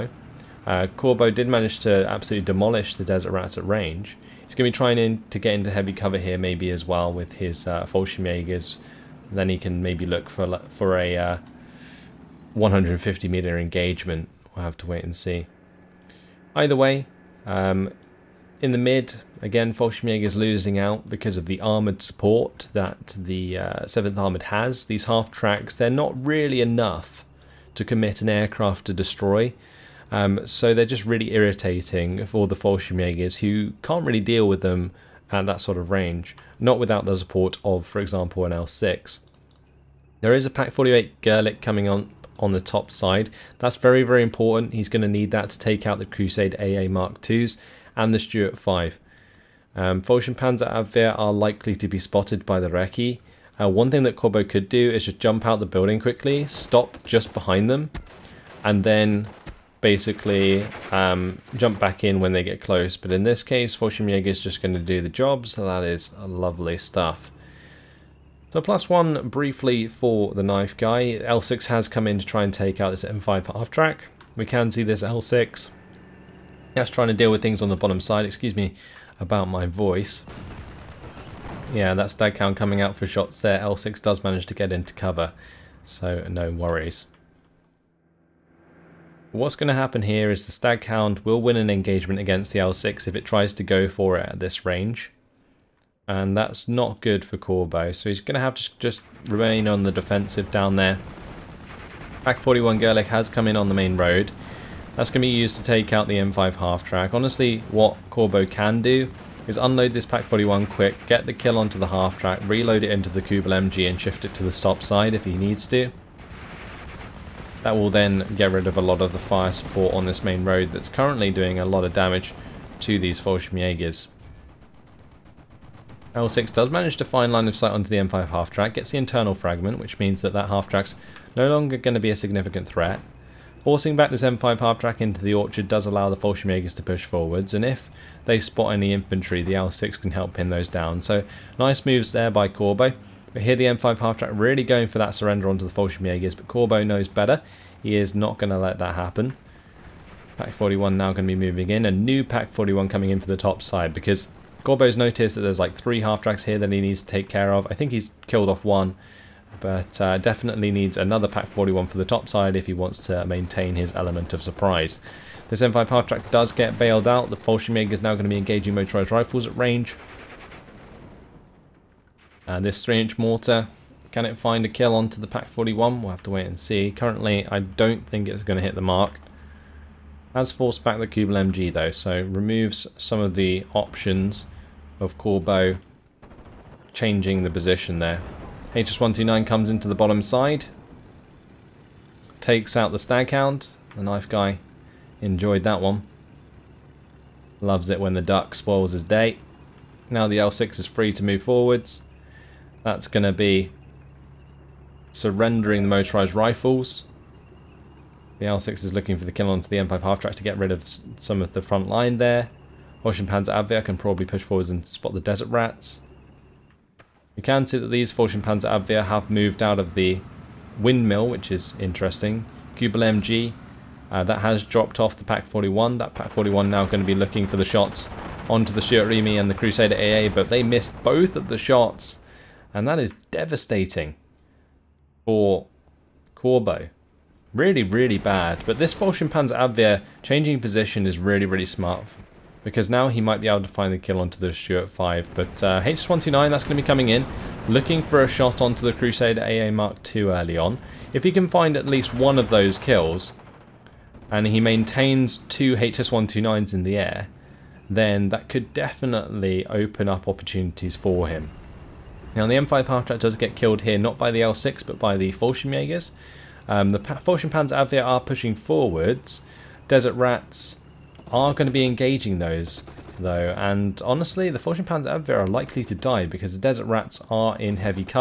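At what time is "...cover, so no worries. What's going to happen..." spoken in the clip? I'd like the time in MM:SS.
01:24.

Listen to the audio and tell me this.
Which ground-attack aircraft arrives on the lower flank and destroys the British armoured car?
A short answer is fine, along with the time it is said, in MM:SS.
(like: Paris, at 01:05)
HS129, at 03:08.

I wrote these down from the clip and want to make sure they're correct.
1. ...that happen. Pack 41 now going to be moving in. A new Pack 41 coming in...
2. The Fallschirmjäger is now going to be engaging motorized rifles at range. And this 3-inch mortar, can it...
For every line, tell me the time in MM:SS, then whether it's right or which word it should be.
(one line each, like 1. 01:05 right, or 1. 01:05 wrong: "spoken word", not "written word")
1. 02:28 right
2. 02:47 right.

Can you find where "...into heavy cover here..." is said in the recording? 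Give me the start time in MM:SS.
00:05.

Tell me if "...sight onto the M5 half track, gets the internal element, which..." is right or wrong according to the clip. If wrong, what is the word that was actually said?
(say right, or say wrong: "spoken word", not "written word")
wrong: "fragment", not "element".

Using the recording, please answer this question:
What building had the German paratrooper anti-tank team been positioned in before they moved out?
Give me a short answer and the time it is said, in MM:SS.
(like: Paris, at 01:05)
windmill, at 03:40.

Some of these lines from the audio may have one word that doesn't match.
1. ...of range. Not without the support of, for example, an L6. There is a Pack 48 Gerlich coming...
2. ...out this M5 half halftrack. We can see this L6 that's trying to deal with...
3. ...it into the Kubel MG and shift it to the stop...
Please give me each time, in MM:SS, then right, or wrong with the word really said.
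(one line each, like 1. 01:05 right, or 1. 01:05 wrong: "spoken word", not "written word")
1. 00:35 right
2. 01:12 wrong: "track", not "halftrack"
3. 01:52 right.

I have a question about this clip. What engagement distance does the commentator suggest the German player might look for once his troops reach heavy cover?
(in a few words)
150 meters.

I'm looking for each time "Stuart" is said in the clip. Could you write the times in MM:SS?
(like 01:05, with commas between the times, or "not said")
00:48, 04:04.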